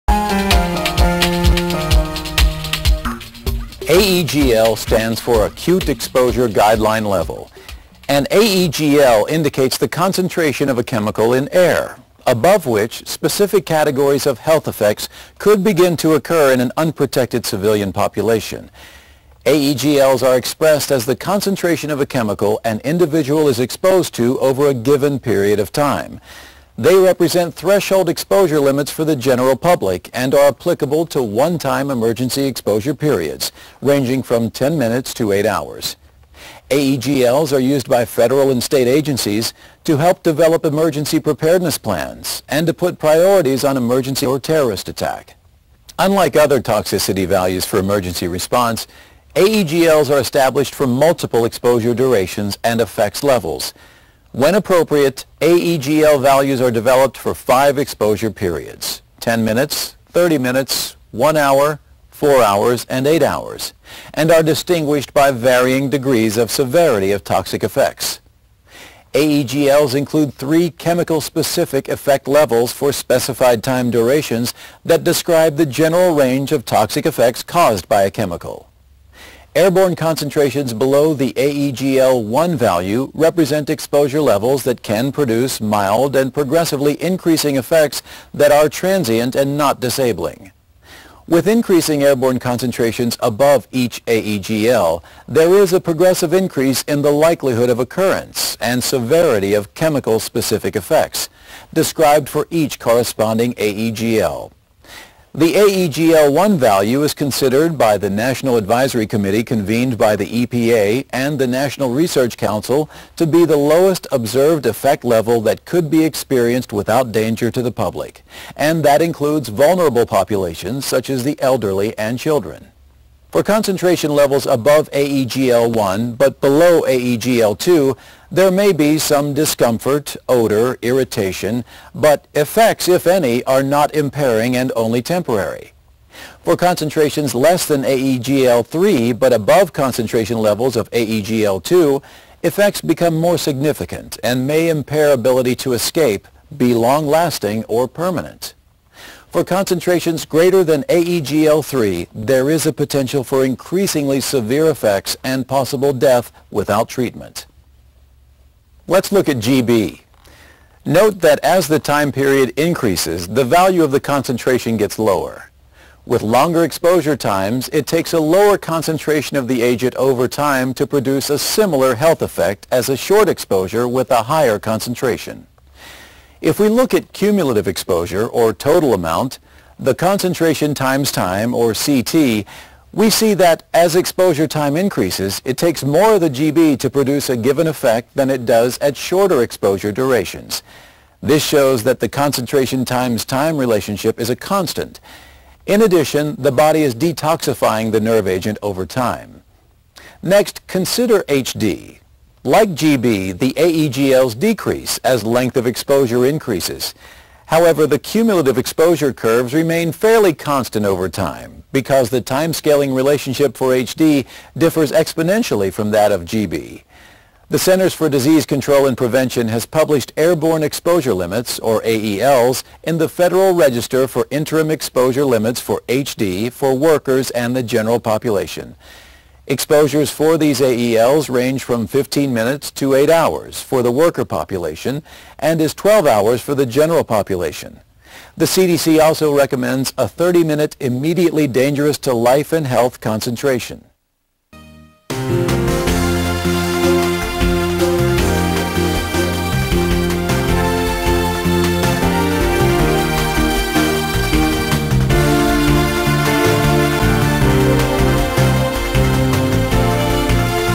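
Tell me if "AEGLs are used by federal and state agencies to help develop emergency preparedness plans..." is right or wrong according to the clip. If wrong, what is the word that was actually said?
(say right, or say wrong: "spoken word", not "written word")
right.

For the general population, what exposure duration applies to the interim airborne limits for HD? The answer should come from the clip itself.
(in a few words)
12 hours.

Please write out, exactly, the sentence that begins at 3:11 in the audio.
This shows that the concentration times time relationship is a constant.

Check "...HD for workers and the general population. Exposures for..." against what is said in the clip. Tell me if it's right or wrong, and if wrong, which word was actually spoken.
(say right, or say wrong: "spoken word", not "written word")
right.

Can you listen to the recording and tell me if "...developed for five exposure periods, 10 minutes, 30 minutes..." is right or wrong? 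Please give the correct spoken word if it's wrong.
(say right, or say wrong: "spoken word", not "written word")
right.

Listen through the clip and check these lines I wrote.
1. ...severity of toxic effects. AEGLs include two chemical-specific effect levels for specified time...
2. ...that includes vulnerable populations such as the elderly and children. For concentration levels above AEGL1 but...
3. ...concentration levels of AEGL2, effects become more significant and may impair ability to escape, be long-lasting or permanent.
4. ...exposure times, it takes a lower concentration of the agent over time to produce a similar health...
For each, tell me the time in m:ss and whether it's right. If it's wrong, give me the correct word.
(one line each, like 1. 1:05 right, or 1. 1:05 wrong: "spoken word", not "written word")
1. 1:06 wrong: "three", not "two"
2. 1:58 right
3. 2:19 right
4. 2:46 right.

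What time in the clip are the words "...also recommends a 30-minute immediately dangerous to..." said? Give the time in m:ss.
3:59.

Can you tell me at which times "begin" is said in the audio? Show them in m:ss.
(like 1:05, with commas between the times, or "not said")
0:15.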